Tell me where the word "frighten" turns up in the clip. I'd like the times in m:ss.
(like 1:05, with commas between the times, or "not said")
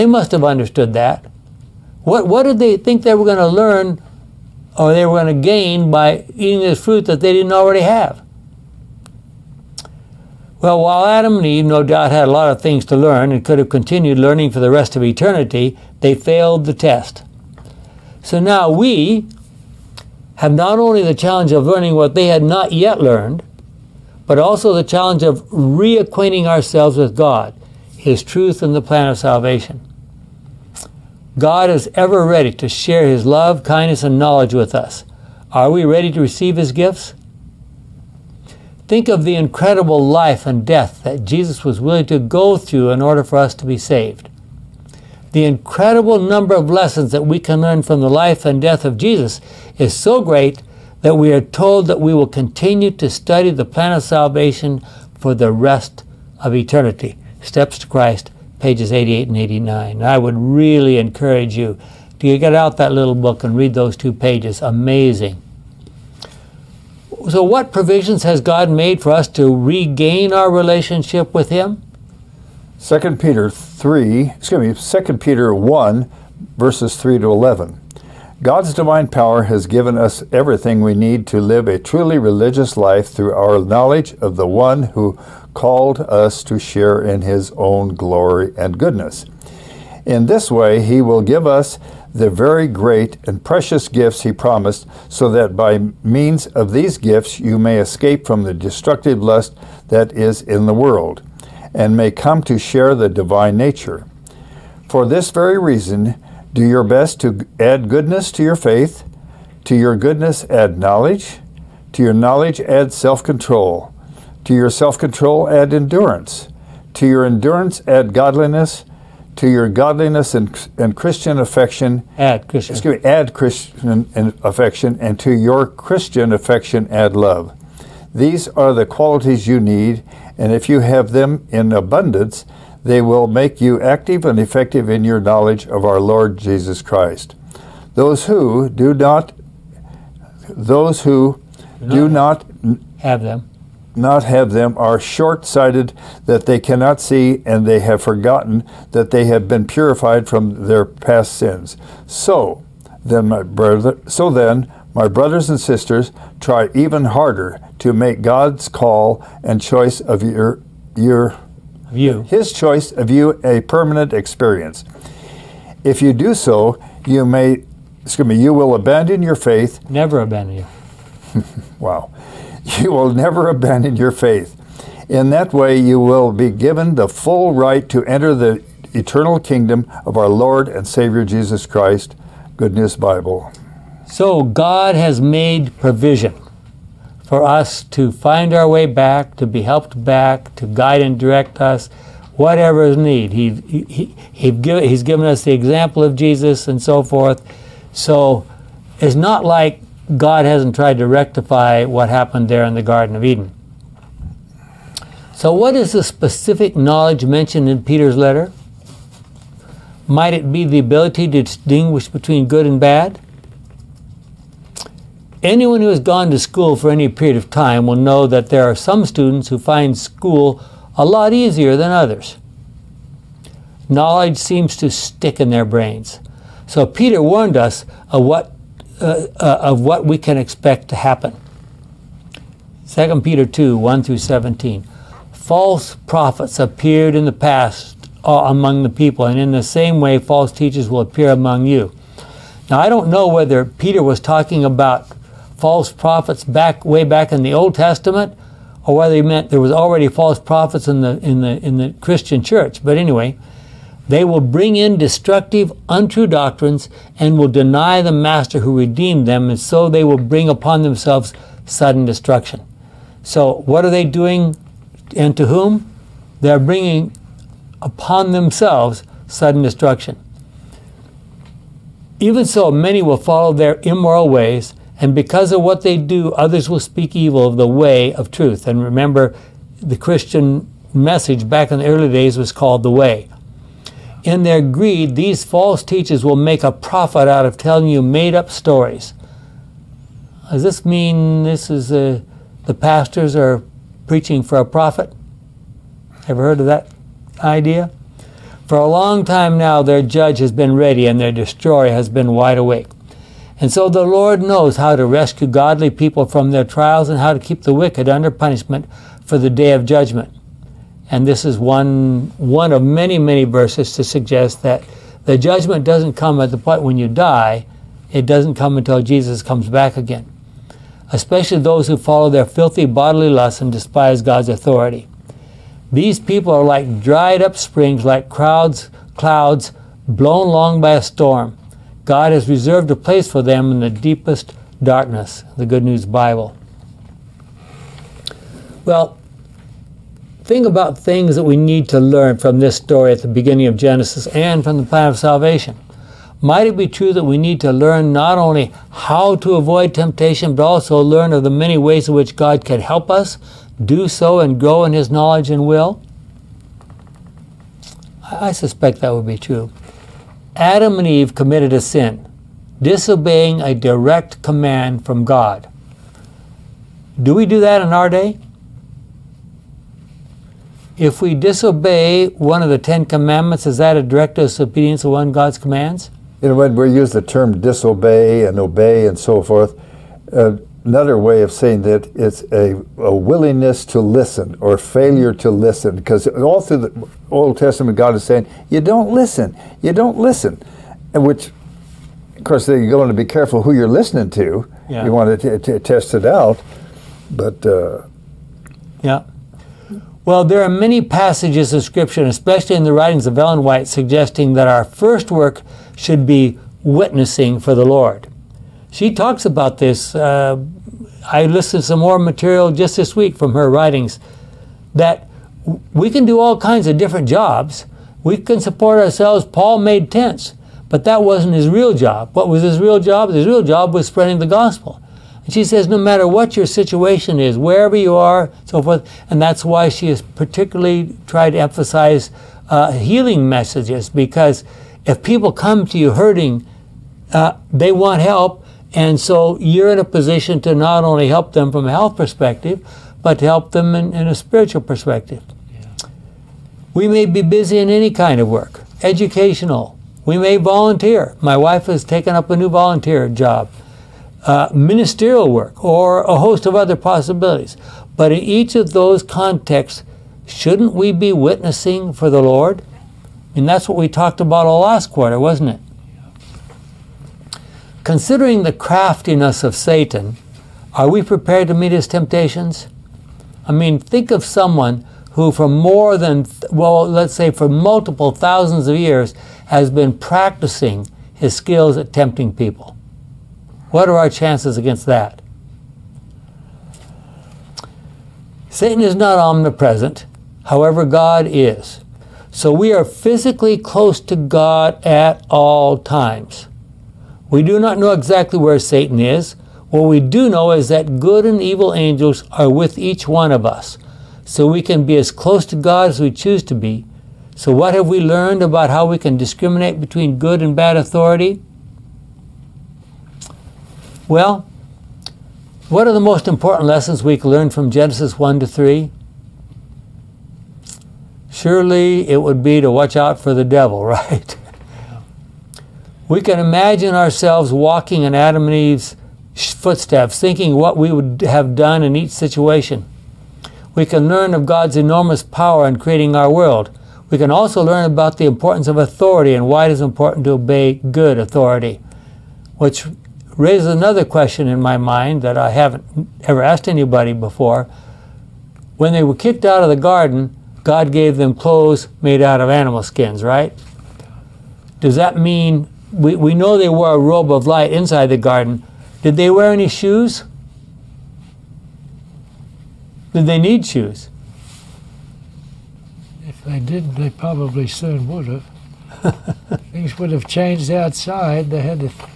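not said.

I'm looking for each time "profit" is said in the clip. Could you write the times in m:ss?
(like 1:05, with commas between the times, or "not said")
4:46, 4:54.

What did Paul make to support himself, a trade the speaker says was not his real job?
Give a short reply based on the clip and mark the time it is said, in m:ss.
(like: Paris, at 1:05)
tents, at 7:00.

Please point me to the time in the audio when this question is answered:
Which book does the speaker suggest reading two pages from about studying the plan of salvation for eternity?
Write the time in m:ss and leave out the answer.
0:57.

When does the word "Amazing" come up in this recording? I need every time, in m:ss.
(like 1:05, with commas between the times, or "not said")
1:04.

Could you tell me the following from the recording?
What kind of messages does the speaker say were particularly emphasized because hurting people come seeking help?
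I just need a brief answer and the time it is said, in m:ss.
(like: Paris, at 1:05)
healing messages, at 7:12.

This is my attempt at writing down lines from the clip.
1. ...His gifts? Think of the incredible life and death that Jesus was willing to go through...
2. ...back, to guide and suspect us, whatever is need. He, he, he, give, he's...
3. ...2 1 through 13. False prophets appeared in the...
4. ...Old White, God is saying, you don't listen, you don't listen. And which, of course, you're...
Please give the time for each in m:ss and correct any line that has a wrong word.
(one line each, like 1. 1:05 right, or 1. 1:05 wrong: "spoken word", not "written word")
1. 0:36 right
2. 3:10 wrong: "direct", not "suspect"
3. 3:53 wrong: "17", not "13"
4. 6:27 wrong: "Testament", not "White".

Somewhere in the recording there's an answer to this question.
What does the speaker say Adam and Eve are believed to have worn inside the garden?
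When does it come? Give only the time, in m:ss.
9:17.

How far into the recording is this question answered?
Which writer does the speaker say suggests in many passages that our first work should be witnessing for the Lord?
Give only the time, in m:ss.
6:43.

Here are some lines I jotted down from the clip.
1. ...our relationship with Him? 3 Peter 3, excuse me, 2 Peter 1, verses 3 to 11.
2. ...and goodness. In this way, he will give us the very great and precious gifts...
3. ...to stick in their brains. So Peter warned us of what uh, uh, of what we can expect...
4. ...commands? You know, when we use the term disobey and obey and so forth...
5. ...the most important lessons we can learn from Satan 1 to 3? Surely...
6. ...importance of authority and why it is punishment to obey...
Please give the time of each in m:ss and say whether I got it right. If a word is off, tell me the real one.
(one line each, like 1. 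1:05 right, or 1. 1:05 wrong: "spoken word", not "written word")
1. 1:10 wrong: "2", not "3"
2. 1:28 right
3. 3:44 right
4. 6:15 right
5. 8:36 wrong: "Genesis", not "Satan"
6. 8:58 wrong: "important", not "punishment".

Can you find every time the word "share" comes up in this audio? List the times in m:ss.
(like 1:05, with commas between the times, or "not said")
0:32, 1:26, 1:42.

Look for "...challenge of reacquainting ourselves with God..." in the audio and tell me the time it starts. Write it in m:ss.
0:24.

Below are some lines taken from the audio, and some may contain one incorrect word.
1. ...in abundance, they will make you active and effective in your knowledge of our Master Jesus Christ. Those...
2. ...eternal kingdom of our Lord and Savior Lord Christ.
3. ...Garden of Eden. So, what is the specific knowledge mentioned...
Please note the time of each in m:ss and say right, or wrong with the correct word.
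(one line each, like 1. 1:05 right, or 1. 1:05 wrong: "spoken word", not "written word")
1. 2:11 wrong: "Lord", not "Master"
2. 2:58 wrong: "Jesus", not "Lord"
3. 3:22 right.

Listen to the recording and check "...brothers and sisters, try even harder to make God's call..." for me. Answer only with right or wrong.
right.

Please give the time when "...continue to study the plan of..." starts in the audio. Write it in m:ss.
0:52.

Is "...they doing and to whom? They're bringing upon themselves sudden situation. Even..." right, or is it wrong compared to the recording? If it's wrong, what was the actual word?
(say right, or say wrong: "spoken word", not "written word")
wrong: "destruction", not "situation".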